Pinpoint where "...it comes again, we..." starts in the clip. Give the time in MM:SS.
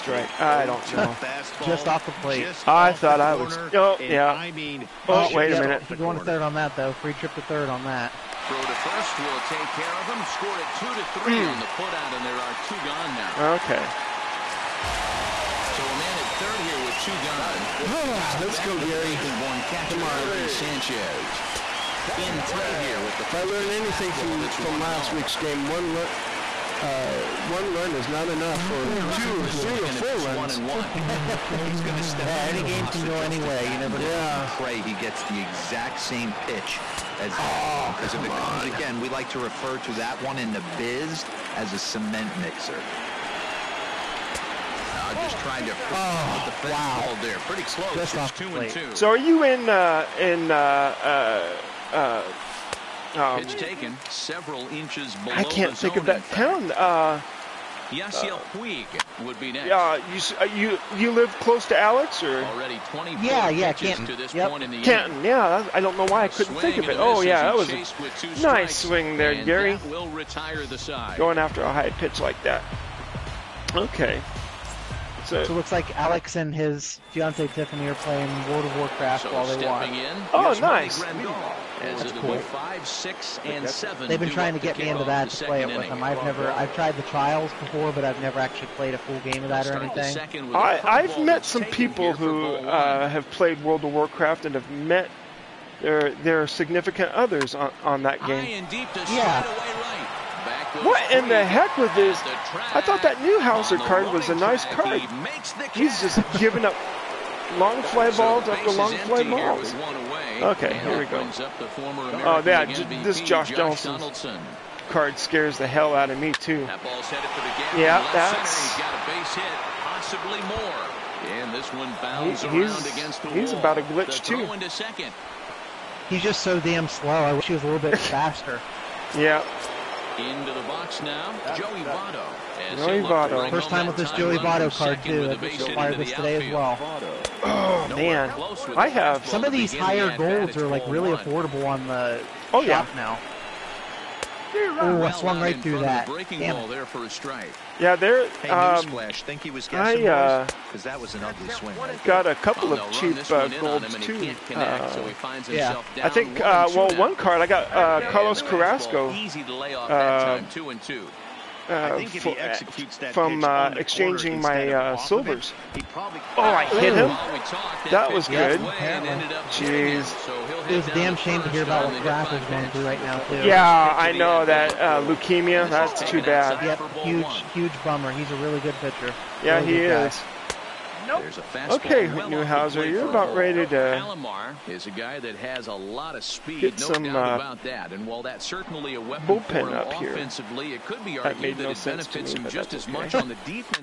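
00:38.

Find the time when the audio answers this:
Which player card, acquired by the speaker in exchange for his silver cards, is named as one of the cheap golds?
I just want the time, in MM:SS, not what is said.
02:38.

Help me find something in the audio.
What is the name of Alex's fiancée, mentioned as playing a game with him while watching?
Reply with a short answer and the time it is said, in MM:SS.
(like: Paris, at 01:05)
Tiffany, at 01:17.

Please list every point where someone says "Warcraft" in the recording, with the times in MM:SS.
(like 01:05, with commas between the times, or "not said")
01:18, 01:33.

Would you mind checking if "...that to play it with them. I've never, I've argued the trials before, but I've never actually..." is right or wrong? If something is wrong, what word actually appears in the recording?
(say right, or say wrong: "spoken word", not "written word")
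wrong: "tried", not "argued".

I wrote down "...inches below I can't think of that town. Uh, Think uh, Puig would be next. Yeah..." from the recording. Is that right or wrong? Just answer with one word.
wrong.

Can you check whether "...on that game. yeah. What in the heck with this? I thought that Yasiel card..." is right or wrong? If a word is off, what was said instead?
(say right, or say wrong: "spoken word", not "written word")
wrong: "Newhouser", not "Yasiel".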